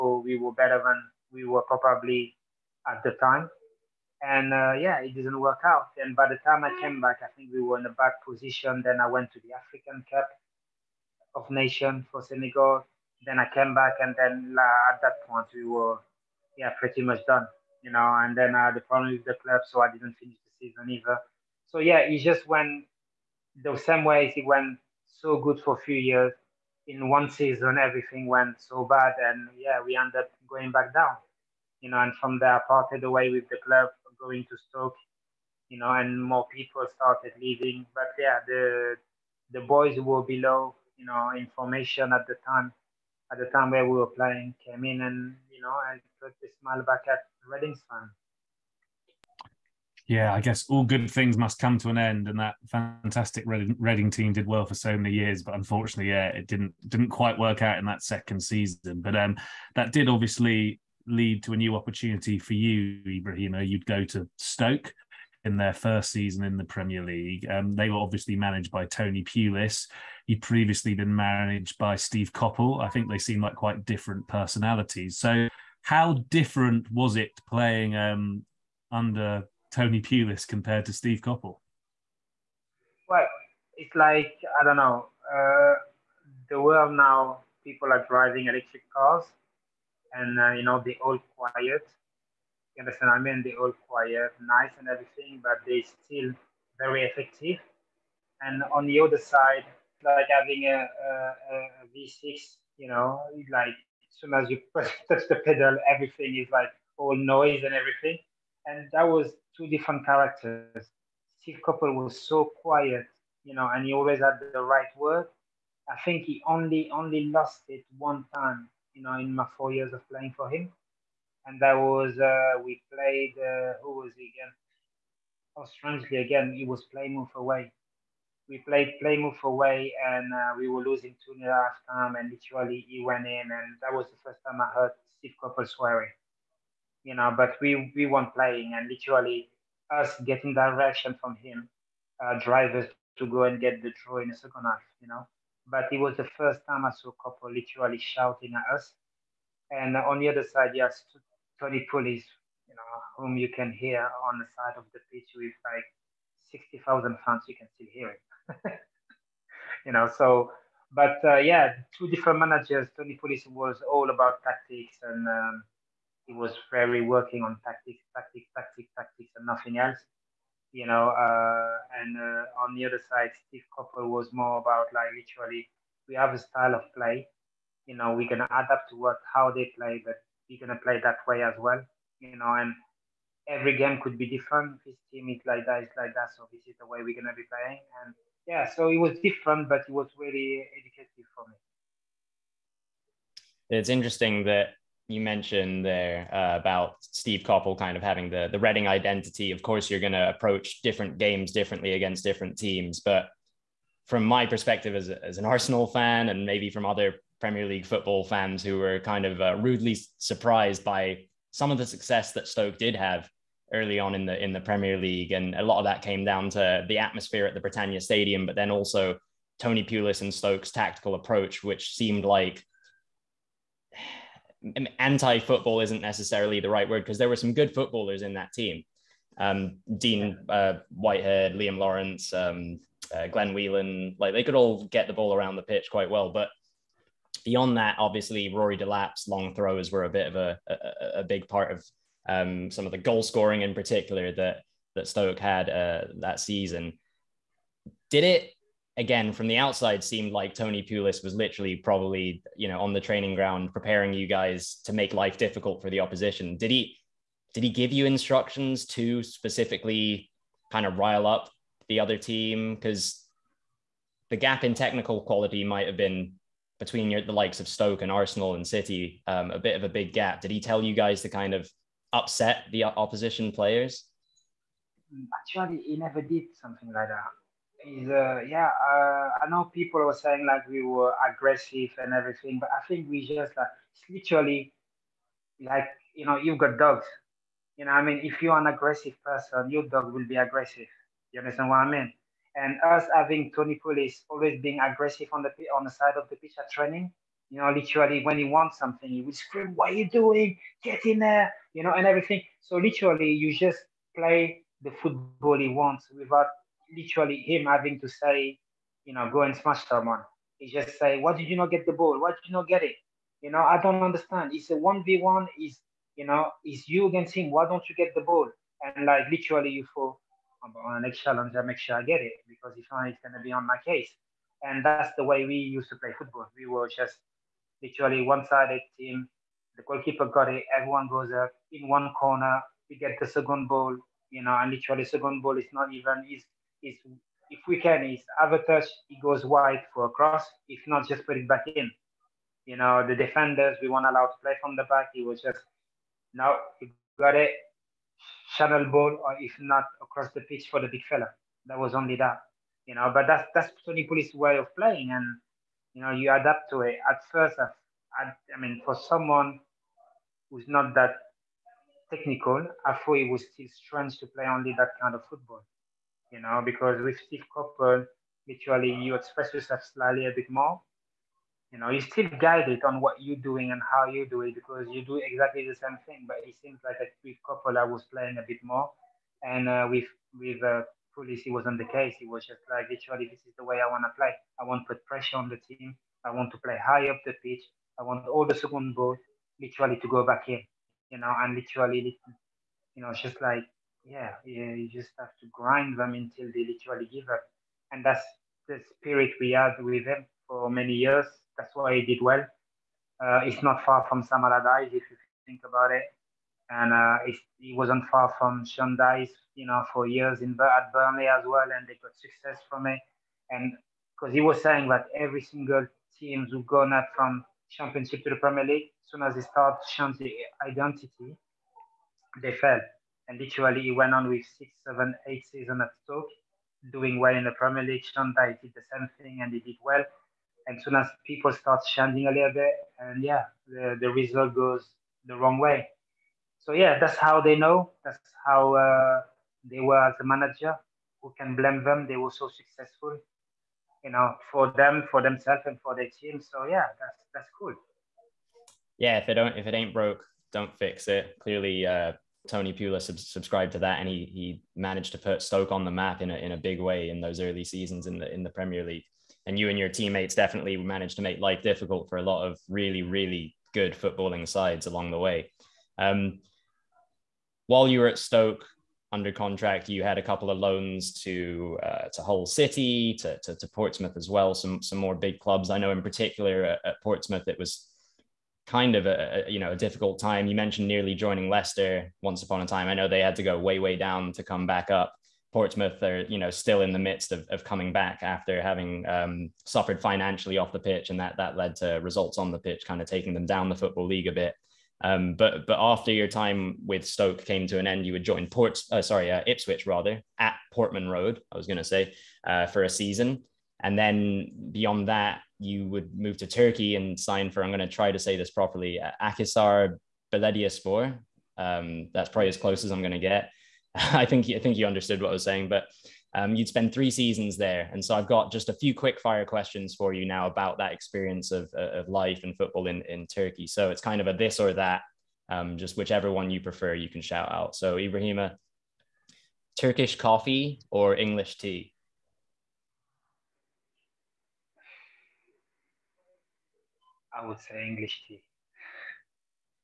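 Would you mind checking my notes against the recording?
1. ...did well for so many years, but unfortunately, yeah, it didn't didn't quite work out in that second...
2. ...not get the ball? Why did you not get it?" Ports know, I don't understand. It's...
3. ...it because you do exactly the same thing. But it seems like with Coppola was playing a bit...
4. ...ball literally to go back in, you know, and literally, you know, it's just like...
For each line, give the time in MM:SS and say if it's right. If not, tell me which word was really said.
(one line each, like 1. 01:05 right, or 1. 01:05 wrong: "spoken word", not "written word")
1. 00:54 right
2. 05:11 wrong: "You", not "Ports"
3. 06:14 right
4. 06:28 right.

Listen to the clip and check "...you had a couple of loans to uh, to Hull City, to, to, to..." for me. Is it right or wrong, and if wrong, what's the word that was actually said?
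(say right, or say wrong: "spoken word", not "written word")
right.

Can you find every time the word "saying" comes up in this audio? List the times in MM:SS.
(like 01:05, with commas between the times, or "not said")
04:40, 06:54, 08:35.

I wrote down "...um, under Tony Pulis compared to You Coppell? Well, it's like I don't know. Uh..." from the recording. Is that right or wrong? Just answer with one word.
wrong.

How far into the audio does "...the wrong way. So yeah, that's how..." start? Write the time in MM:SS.
07:15.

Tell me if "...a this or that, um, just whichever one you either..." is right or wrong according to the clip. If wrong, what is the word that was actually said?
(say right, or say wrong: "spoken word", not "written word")
wrong: "prefer", not "either".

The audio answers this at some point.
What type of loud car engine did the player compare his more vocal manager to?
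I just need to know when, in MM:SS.
01:41.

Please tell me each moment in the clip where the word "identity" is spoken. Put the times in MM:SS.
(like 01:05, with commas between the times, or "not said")
03:18, 07:00.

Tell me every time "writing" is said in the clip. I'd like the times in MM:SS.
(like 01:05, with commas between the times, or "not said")
not said.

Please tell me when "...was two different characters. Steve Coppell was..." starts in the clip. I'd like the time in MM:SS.
01:49.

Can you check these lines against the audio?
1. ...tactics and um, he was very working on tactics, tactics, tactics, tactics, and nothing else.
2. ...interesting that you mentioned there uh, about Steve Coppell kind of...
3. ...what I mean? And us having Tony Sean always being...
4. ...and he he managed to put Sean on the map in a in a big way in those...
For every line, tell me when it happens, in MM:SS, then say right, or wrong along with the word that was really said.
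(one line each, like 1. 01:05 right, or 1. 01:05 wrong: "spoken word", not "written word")
1. 02:44 right
2. 03:13 right
3. 04:51 wrong: "Pulis", not "Sean"
4. 07:33 wrong: "Stoke", not "Sean".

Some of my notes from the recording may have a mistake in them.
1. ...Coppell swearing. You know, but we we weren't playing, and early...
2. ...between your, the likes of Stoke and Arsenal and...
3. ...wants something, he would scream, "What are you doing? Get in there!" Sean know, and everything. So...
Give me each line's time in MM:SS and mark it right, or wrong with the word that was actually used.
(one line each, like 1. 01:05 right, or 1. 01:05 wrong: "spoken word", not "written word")
1. 02:15 wrong: "literally", not "early"
2. 04:26 right
3. 04:58 wrong: "You", not "Sean".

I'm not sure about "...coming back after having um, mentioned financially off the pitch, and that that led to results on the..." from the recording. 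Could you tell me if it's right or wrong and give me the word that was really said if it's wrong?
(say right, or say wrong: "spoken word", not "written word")
wrong: "suffered", not "mentioned".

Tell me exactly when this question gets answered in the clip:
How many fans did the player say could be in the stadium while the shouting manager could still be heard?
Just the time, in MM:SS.
02:36.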